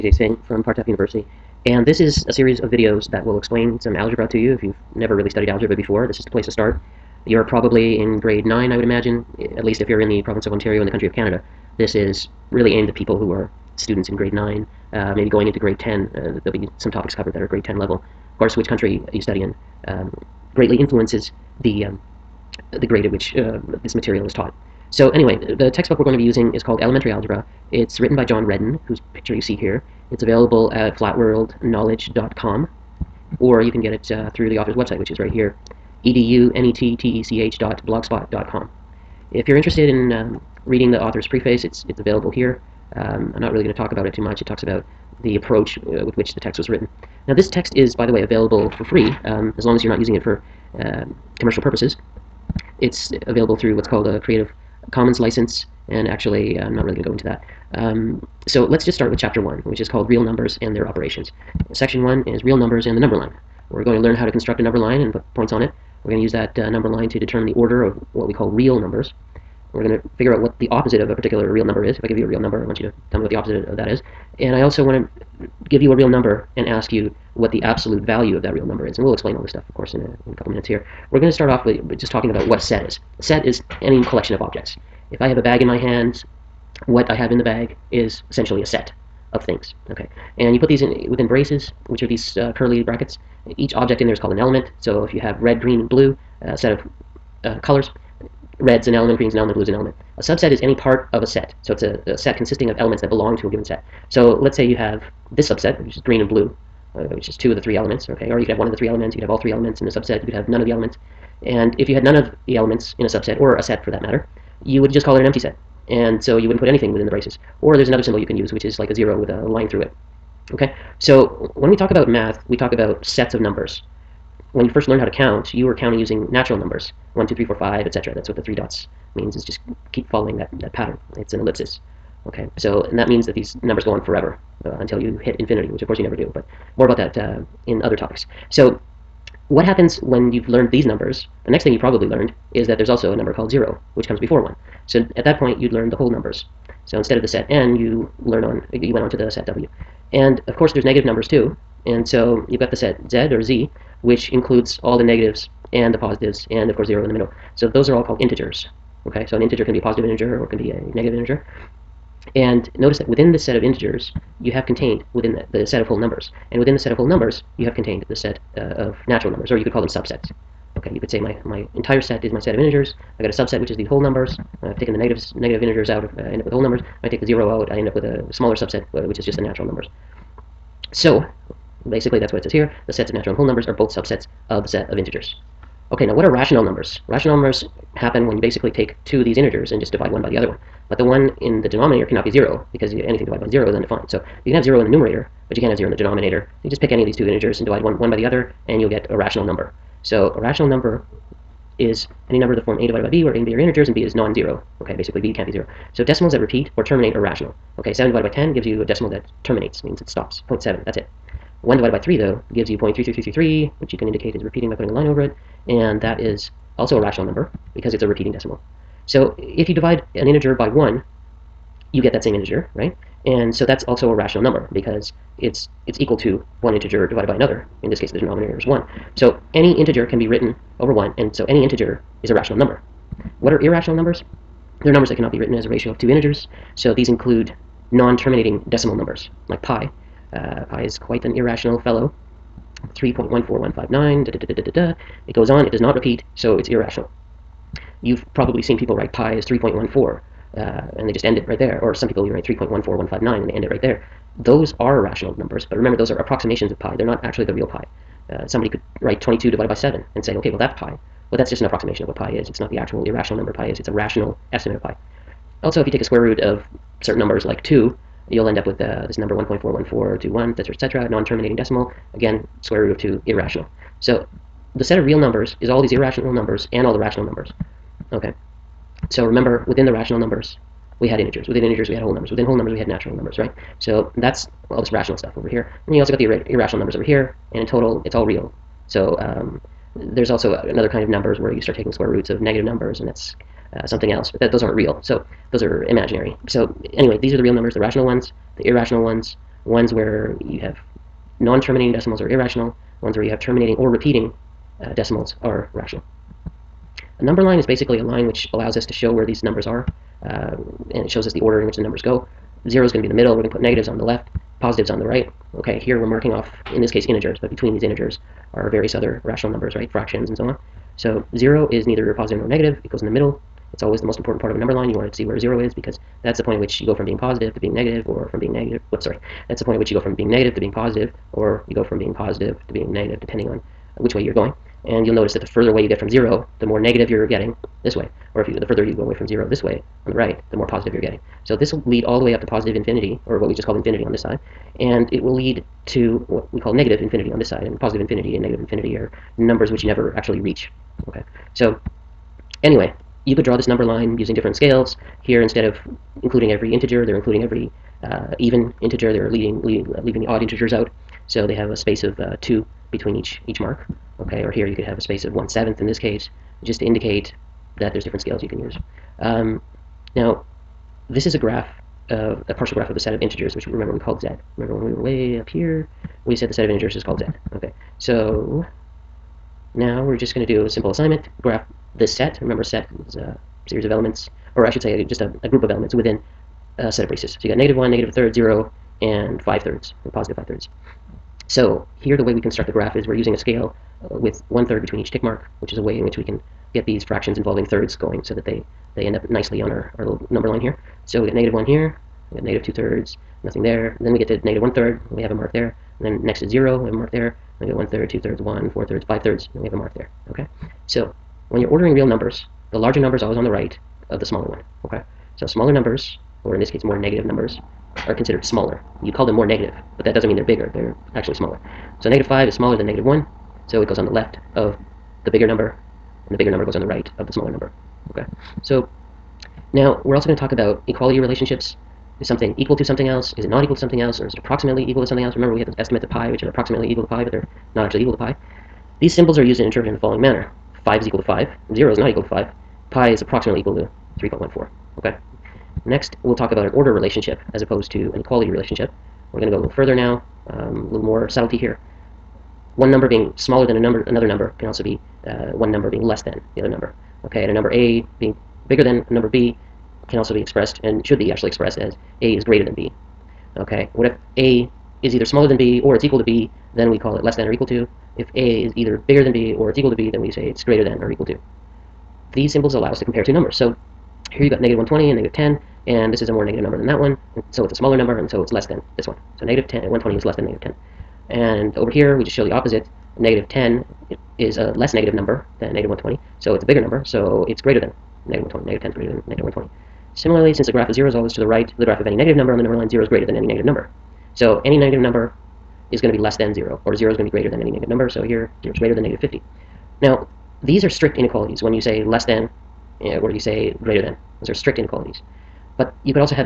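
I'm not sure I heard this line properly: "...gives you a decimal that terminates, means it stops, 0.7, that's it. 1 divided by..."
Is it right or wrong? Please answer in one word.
right.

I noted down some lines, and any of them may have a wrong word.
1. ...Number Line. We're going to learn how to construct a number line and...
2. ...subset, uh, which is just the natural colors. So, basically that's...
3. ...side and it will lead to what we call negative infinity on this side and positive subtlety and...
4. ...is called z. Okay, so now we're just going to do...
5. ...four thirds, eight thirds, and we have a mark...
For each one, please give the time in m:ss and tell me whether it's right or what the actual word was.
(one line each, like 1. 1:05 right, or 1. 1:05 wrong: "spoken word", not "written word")
1. 1:02 right
2. 2:58 wrong: "numbers", not "colors"
3. 5:44 wrong: "infinity", not "subtlety"
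4. 6:16 right
5. 6:48 wrong: "five", not "eight".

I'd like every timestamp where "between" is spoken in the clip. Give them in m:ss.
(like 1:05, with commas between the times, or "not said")
5:17, 6:02, 6:34.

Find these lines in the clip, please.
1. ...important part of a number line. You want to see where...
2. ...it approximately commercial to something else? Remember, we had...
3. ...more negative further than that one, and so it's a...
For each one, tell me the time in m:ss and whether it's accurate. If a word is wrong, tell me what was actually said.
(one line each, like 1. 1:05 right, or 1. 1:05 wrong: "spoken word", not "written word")
1. 5:24 right
2. 7:14 wrong: "equal", not "commercial"
3. 7:56 wrong: "number", not "further".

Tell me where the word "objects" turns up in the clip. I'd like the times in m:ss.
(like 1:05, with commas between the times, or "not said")
1:24, 1:33.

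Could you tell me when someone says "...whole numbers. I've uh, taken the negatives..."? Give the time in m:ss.
2:53.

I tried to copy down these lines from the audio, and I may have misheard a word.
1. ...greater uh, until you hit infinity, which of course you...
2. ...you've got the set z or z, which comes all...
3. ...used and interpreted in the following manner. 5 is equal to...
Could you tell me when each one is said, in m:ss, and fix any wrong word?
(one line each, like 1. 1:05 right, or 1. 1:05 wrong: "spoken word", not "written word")
1. 2:14 wrong: "forever", not "greater"
2. 2:32 wrong: "includes", not "comes"
3. 7:19 right.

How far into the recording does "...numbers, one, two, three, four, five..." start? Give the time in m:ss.
2:06.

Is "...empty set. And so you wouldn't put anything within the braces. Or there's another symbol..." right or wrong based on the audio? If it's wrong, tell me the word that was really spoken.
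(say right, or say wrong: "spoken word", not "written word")
right.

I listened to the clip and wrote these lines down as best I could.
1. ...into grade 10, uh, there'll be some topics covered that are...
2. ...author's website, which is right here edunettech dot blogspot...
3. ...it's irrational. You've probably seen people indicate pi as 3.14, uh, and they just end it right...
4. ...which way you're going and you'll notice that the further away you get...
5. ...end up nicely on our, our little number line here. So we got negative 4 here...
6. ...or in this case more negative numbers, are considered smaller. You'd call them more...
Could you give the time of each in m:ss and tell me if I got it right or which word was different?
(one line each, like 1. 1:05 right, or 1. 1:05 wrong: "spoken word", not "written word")
1. 0:15 right
2. 0:34 right
3. 4:06 wrong: "write", not "indicate"
4. 5:33 right
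5. 6:39 wrong: "1", not "4"
6. 6:56 right.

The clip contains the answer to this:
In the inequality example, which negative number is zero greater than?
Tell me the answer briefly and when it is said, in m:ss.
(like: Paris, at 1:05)
-50, at 8:19.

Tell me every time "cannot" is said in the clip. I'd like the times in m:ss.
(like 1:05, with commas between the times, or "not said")
3:12, 3:55.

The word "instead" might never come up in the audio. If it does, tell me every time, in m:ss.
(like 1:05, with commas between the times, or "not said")
2:26, 5:55.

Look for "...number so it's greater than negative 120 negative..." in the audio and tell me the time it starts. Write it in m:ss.
8:06.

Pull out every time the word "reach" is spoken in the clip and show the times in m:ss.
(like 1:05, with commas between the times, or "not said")
5:50.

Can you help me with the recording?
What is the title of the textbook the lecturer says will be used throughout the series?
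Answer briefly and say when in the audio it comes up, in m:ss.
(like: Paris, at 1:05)
Elementary Algebra, at 0:26.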